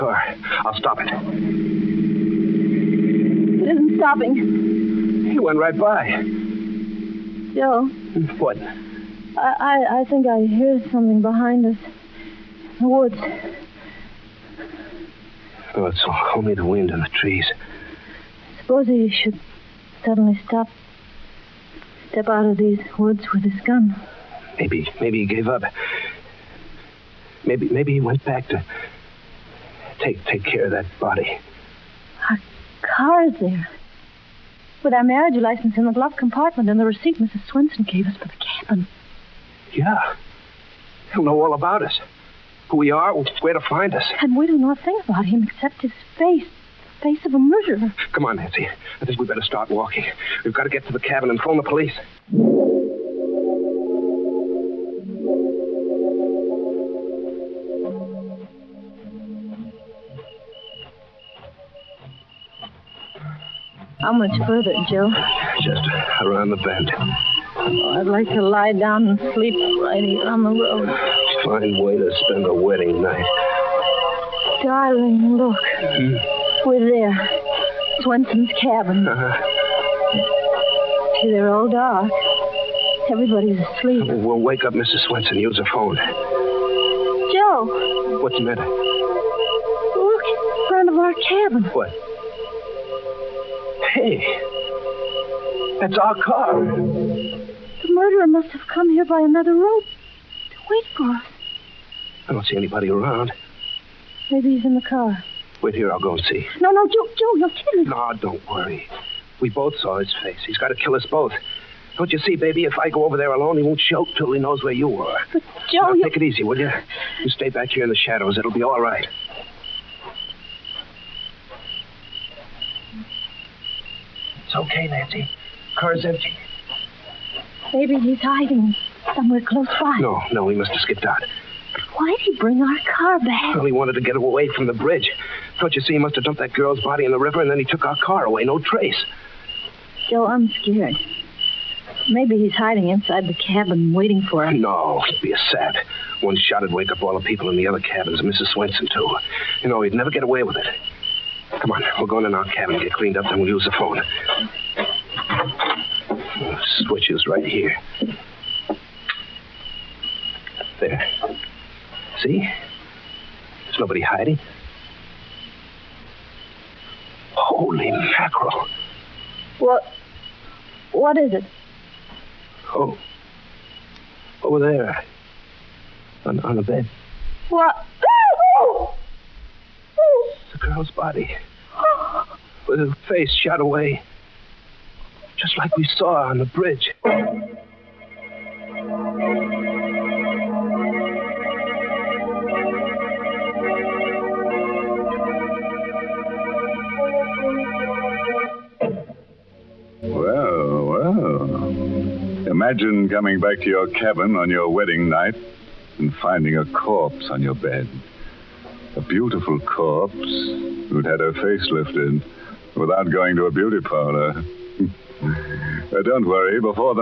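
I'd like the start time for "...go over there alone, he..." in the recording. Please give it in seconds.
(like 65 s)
112 s.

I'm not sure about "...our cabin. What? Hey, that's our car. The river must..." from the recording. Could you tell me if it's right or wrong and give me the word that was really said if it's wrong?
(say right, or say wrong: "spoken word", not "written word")
wrong: "murderer", not "river".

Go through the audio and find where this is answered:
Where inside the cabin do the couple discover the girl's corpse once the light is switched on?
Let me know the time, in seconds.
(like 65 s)
176 s.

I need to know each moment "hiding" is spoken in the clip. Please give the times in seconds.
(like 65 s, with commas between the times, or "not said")
128 s, 142 s, 164 s.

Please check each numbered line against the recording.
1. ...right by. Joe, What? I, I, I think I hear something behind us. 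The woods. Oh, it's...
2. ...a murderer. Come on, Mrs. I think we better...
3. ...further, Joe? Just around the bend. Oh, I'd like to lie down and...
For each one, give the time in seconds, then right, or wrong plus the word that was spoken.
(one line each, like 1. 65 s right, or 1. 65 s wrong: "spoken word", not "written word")
1. 5 s right
2. 47 s wrong: "Nancy", not "Mrs"
3. 64 s right.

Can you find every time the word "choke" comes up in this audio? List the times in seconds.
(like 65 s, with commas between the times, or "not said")
113 s.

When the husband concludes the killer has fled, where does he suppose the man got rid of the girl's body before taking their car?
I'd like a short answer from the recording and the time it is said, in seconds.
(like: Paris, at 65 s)
The river, at 137 s.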